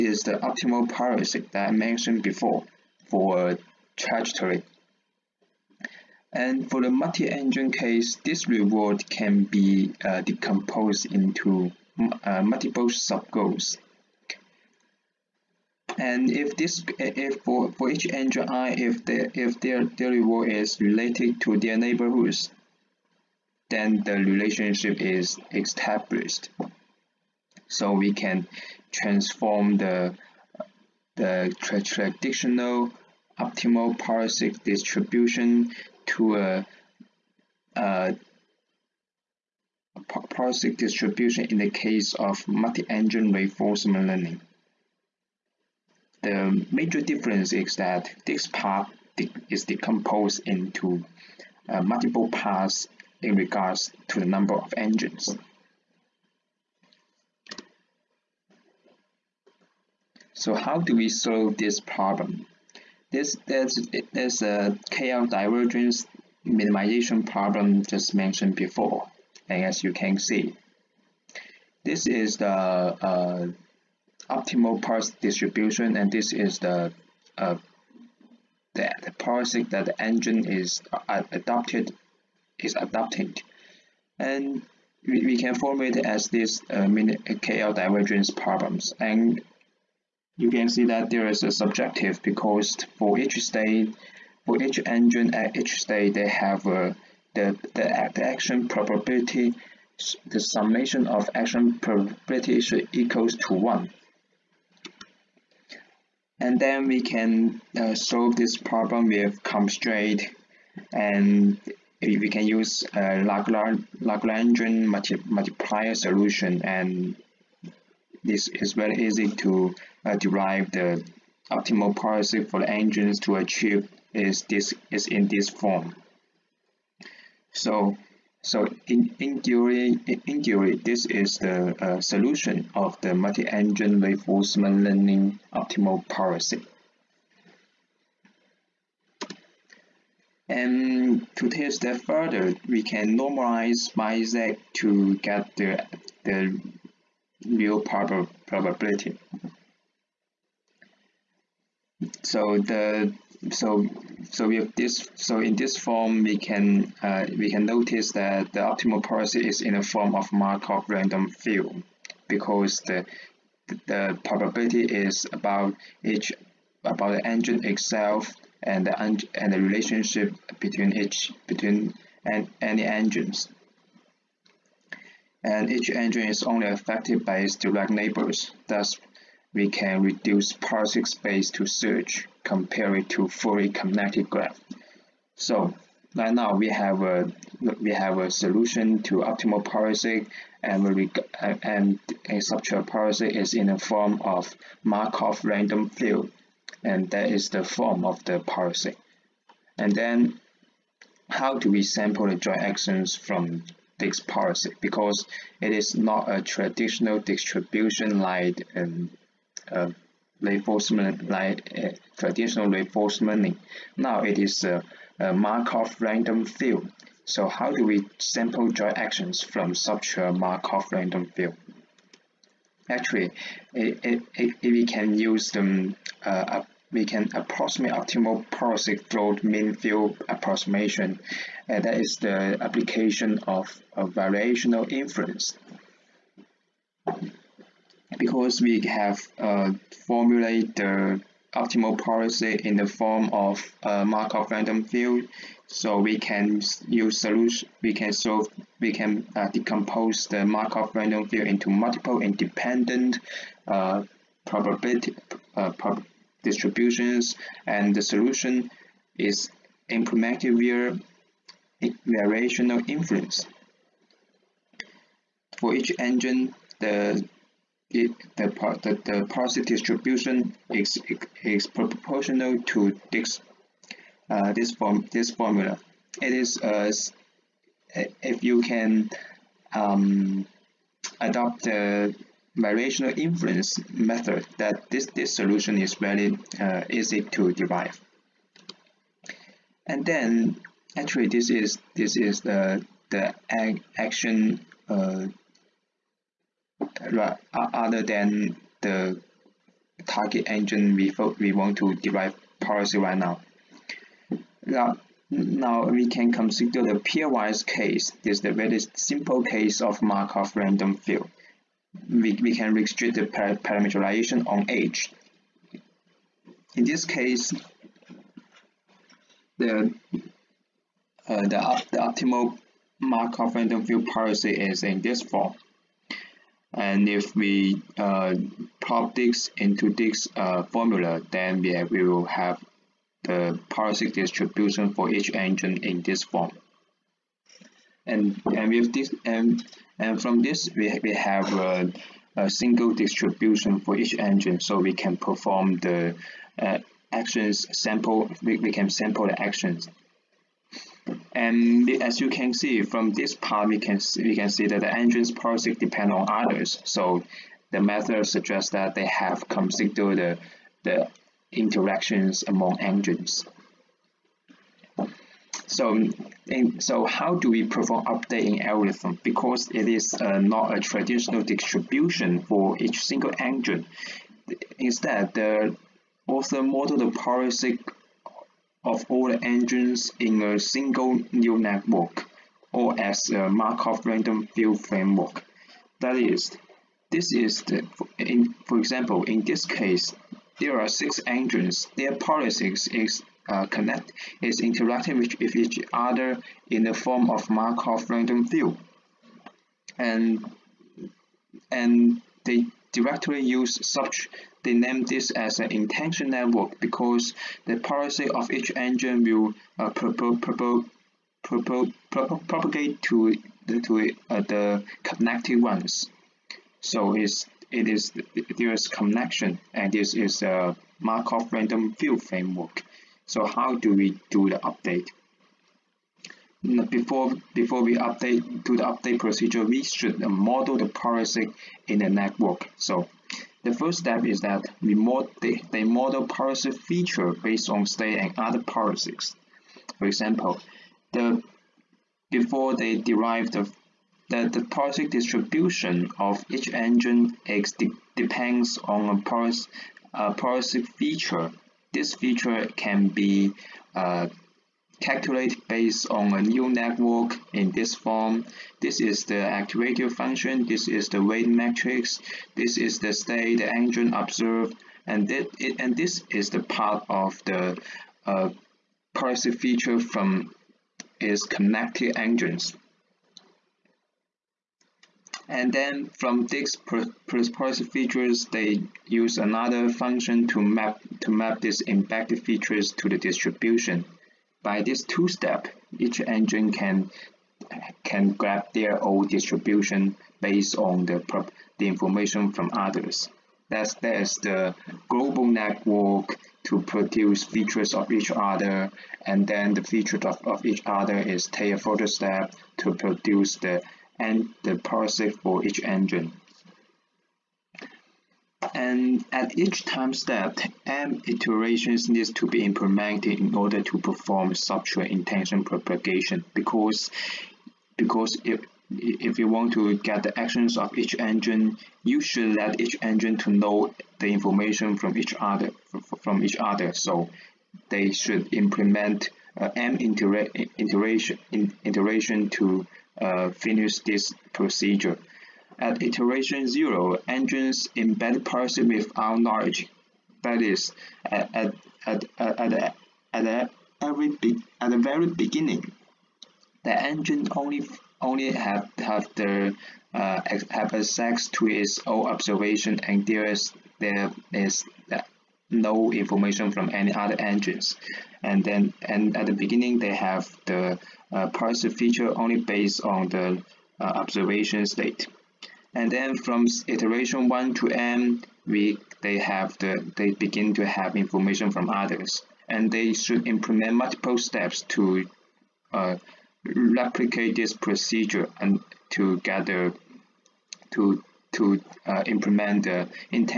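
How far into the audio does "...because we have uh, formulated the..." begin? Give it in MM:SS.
03:58.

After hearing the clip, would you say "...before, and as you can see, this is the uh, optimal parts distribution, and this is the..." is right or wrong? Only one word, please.
right.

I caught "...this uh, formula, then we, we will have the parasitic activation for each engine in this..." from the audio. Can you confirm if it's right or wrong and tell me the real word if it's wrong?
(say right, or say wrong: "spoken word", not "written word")
wrong: "distribution", not "activation".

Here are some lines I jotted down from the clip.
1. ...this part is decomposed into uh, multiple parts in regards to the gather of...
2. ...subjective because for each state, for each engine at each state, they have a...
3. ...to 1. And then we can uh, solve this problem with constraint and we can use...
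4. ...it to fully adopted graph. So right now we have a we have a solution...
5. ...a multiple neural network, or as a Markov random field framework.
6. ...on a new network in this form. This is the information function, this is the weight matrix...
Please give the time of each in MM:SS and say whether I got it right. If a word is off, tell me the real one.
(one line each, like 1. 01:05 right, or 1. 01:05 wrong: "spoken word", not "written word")
1. 00:48 wrong: "number", not "gather"
2. 01:31 right
3. 01:43 right
4. 03:02 wrong: "connected", not "adopted"
5. 06:20 wrong: "single", not "multiple"
6. 07:36 wrong: "activation", not "information".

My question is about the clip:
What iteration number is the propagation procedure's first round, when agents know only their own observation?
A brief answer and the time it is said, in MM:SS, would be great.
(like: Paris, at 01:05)
0, at 08:56.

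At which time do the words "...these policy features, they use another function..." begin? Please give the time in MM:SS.
07:56.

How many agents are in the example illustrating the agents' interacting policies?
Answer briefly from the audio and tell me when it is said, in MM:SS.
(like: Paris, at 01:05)
6, at 06:30.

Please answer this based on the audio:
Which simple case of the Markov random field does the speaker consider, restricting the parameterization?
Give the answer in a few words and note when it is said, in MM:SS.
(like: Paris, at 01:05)
pairwise case, at 05:07.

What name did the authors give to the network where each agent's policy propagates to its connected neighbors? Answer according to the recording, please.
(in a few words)
intention network.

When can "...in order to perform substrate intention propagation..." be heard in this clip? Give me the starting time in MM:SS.
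08:33.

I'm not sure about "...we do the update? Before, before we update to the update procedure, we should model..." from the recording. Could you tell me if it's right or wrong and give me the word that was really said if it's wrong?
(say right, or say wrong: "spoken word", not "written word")
right.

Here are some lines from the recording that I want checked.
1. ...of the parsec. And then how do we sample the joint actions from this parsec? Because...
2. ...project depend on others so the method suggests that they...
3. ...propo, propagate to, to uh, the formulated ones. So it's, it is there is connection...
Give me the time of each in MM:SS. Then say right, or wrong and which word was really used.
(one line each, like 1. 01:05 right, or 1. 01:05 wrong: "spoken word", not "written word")
1. 03:18 right
2. 05:55 right
3. 06:52 wrong: "connected", not "formulated".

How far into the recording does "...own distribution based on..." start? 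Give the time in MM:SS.
08:09.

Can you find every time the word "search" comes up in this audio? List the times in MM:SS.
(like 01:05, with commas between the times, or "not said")
03:01.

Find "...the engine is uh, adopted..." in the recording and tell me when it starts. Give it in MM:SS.
01:19.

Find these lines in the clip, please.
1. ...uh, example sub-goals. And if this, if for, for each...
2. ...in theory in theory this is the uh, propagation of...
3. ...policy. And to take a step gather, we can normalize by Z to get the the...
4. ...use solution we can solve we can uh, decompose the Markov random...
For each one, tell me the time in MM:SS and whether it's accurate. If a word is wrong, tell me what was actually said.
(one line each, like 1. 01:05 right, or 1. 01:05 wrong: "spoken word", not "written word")
1. 00:12 wrong: "multiple", not "example"
2. 02:09 wrong: "solution", not "propagation"
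3. 02:16 wrong: "further", not "gather"
4. 04:06 right.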